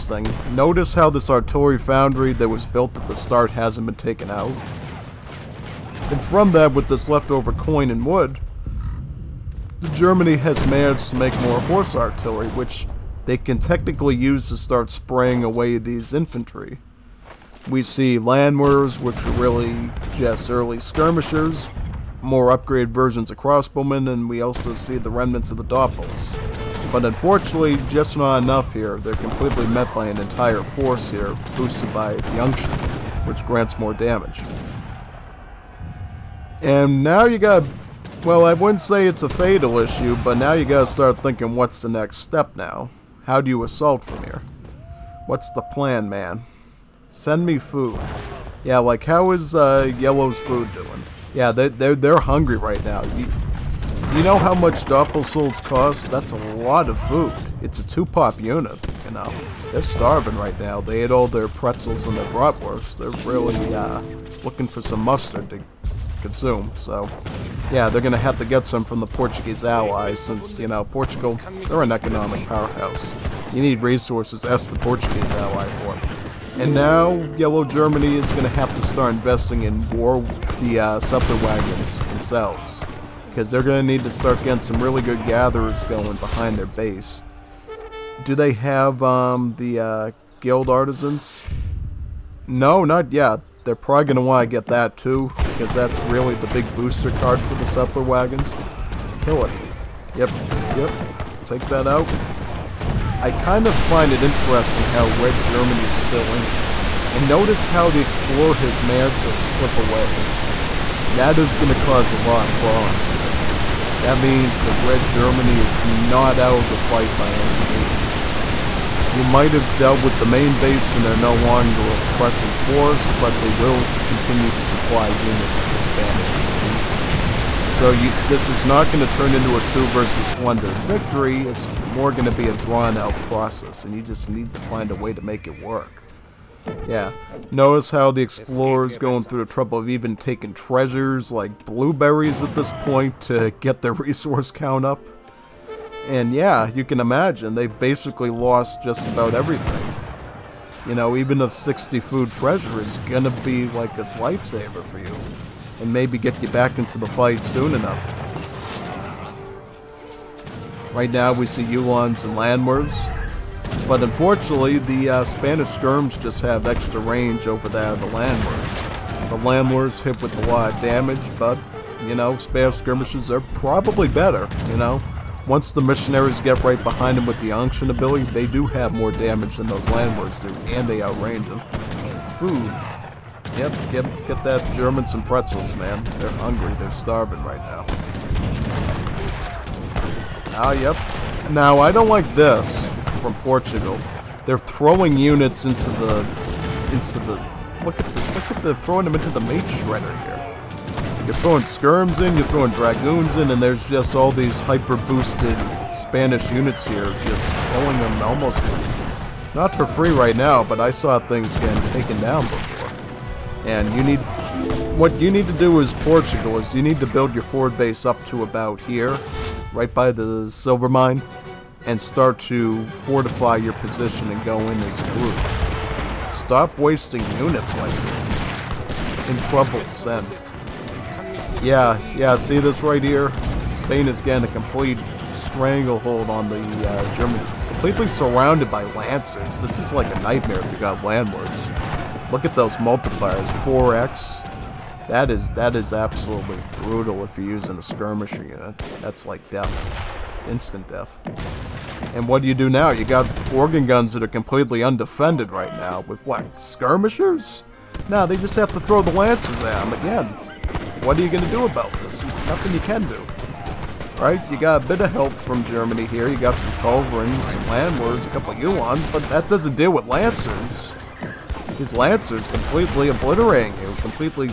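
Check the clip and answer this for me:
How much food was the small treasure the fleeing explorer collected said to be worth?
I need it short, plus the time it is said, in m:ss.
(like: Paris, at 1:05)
60, at 2:31.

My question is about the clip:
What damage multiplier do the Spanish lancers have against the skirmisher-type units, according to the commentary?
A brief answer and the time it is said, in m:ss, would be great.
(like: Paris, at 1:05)
4x, at 4:03.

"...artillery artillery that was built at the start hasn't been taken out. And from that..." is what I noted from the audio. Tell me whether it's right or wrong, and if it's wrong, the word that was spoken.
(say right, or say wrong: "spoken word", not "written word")
wrong: "foundry", not "artillery".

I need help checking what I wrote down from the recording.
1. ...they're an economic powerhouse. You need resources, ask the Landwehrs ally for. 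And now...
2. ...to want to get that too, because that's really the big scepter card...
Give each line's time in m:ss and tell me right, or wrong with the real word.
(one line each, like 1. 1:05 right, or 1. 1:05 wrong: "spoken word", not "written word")
1. 1:11 wrong: "Portuguese", not "Landwehrs"
2. 1:34 wrong: "booster", not "scepter".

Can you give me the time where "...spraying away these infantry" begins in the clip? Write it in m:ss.
0:14.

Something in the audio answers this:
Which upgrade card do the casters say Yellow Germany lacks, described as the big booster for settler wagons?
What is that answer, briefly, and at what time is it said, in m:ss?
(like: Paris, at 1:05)
Guild artisans, at 1:30.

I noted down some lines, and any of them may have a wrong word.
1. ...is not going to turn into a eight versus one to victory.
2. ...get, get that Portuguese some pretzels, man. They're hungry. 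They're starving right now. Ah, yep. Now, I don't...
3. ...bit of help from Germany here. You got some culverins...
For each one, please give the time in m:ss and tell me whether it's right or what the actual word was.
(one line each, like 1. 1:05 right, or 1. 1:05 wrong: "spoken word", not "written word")
1. 2:08 wrong: "two", not "eight"
2. 3:03 wrong: "German", not "Portuguese"
3. 4:24 right.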